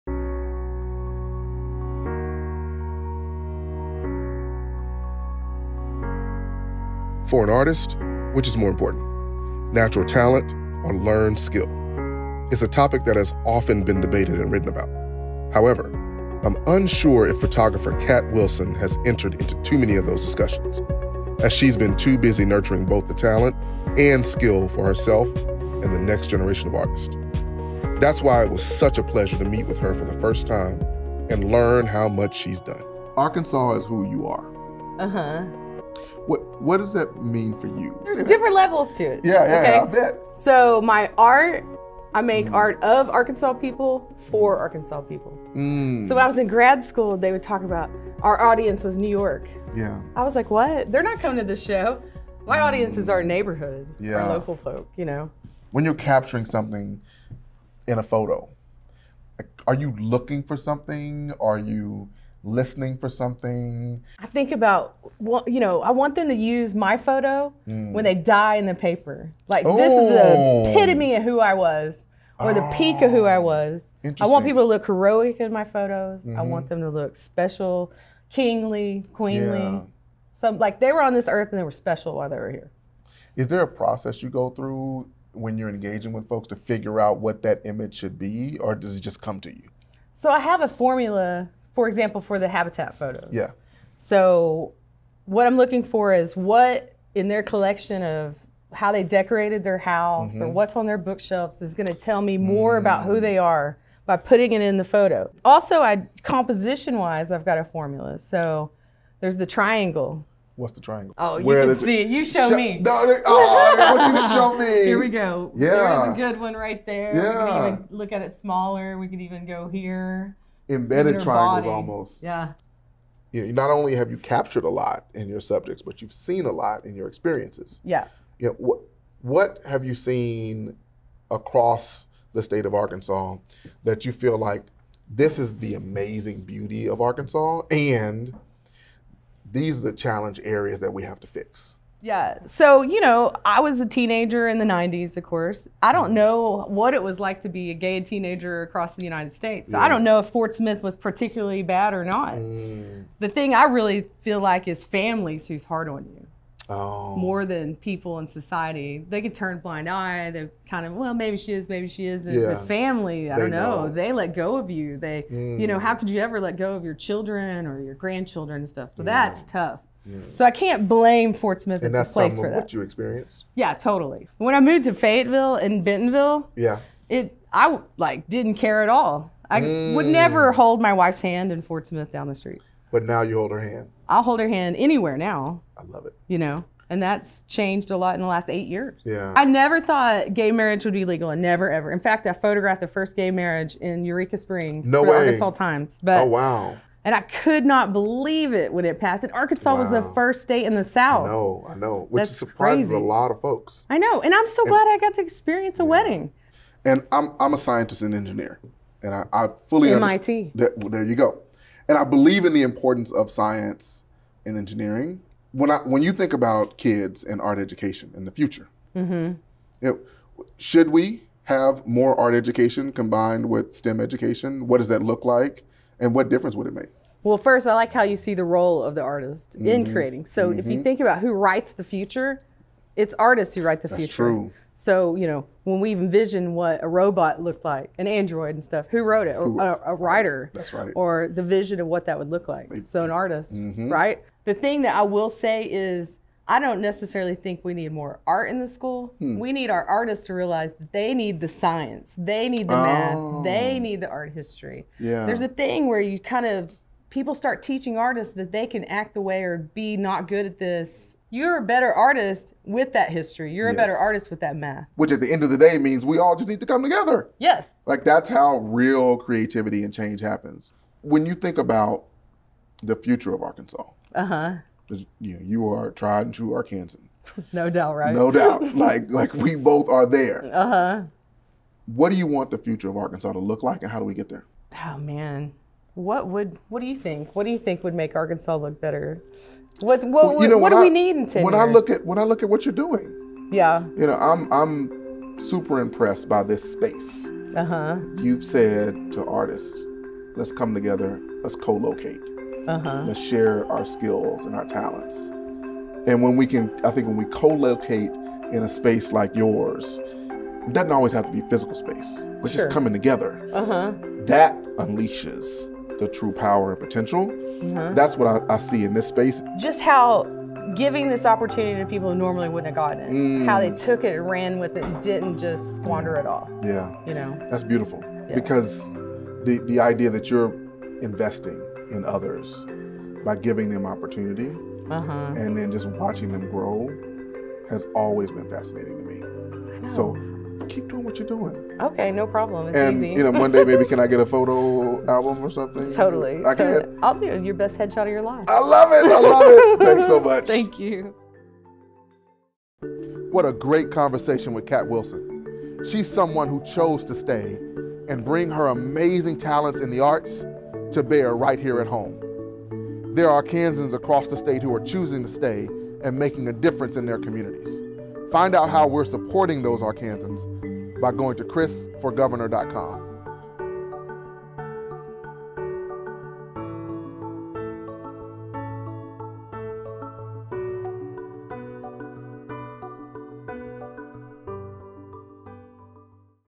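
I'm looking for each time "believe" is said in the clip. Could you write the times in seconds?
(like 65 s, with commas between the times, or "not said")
197 s, 212 s.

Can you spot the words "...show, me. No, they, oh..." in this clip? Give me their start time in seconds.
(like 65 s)
112 s.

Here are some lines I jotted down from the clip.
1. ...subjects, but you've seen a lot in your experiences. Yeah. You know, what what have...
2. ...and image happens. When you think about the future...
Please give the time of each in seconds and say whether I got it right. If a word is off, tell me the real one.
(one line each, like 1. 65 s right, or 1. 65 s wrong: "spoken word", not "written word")
1. 125 s right
2. 269 s wrong: "change", not "image".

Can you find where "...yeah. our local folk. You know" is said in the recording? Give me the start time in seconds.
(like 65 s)
53 s.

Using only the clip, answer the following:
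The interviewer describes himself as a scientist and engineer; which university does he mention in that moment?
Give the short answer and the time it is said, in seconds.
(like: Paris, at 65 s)
MIT, at 209 s.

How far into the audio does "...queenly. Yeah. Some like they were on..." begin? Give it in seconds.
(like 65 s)
79 s.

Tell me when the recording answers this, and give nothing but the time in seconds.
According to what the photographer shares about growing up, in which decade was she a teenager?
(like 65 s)
144 s.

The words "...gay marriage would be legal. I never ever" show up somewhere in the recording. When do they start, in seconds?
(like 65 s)
190 s.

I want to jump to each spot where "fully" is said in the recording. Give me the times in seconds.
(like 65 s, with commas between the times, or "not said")
209 s.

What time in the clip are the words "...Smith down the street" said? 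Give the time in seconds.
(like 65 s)
181 s.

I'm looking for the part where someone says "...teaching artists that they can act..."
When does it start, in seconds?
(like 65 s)
257 s.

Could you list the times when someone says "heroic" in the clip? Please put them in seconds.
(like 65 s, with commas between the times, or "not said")
74 s.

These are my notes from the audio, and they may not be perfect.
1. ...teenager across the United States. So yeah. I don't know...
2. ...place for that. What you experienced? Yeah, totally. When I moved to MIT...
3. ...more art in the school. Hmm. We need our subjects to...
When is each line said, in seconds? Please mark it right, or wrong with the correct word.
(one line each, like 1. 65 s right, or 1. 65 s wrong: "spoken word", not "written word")
1. 148 s right
2. 172 s wrong: "Fayetteville", not "MIT"
3. 247 s wrong: "artists", not "subjects".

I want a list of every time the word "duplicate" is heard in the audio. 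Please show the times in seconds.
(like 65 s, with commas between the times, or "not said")
not said.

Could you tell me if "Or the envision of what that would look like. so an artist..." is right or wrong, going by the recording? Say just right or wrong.
wrong.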